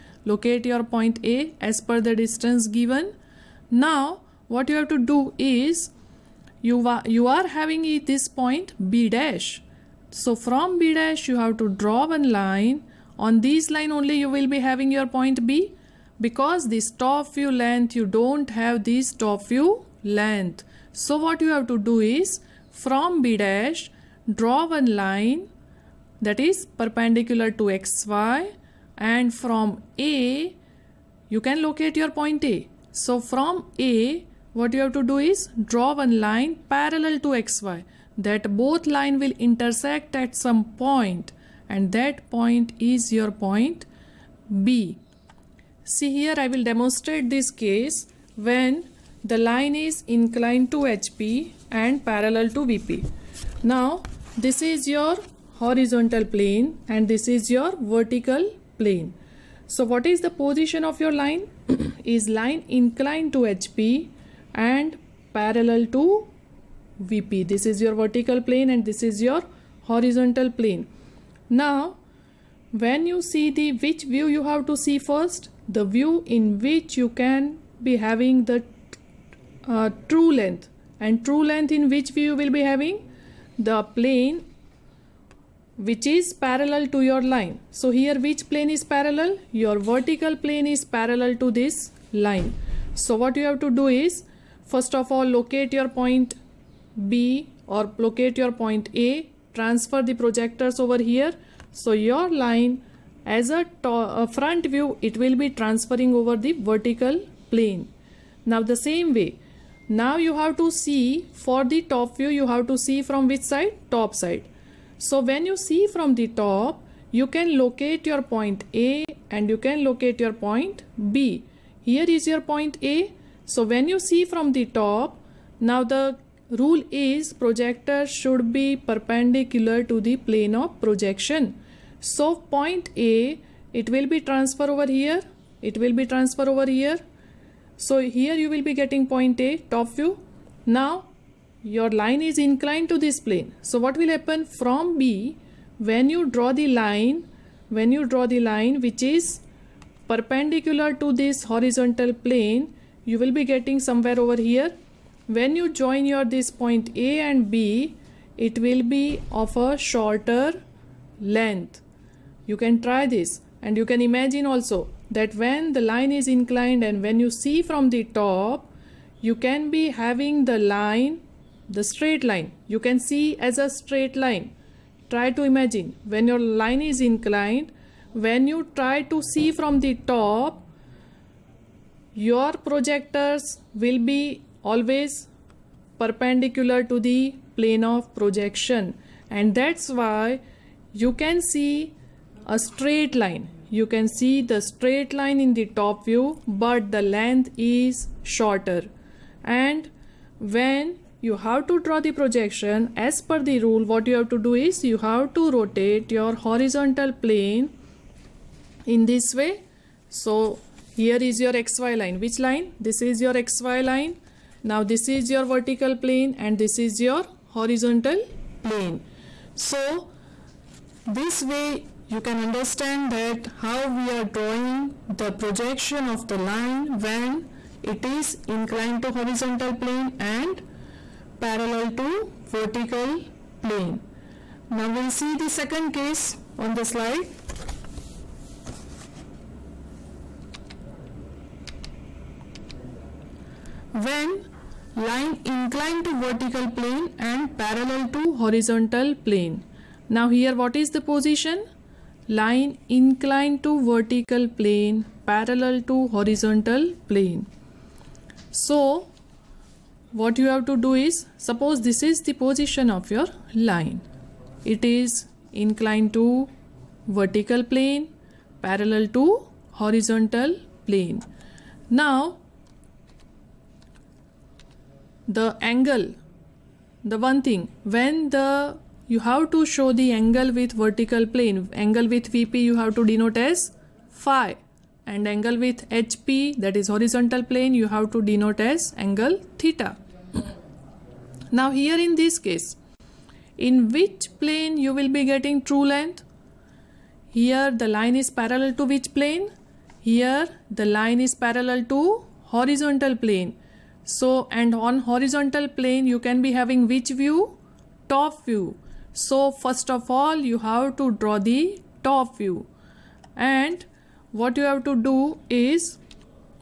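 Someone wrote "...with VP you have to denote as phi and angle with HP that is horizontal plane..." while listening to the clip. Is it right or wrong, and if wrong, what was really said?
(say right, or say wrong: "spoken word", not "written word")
right.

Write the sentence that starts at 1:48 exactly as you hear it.
Now the same way, now you have to see for the top view, you have to see from which side?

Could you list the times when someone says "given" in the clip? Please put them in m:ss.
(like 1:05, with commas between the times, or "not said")
0:02.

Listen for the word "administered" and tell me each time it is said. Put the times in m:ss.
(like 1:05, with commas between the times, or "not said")
not said.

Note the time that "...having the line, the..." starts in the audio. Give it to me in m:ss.
2:49.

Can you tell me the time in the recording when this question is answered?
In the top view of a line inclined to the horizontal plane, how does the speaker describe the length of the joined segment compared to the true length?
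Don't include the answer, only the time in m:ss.
2:39.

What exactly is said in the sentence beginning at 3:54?
Now we'll see the second case on the slide.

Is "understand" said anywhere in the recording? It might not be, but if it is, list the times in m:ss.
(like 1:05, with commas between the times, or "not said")
3:42.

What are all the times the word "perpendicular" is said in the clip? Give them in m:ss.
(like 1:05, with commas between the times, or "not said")
0:26, 2:08, 2:30, 3:06.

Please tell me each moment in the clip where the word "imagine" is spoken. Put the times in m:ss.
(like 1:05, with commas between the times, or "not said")
2:44, 2:55.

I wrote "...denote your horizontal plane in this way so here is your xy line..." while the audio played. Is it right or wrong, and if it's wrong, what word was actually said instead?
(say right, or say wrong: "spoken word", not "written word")
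wrong: "rotate", not "denote".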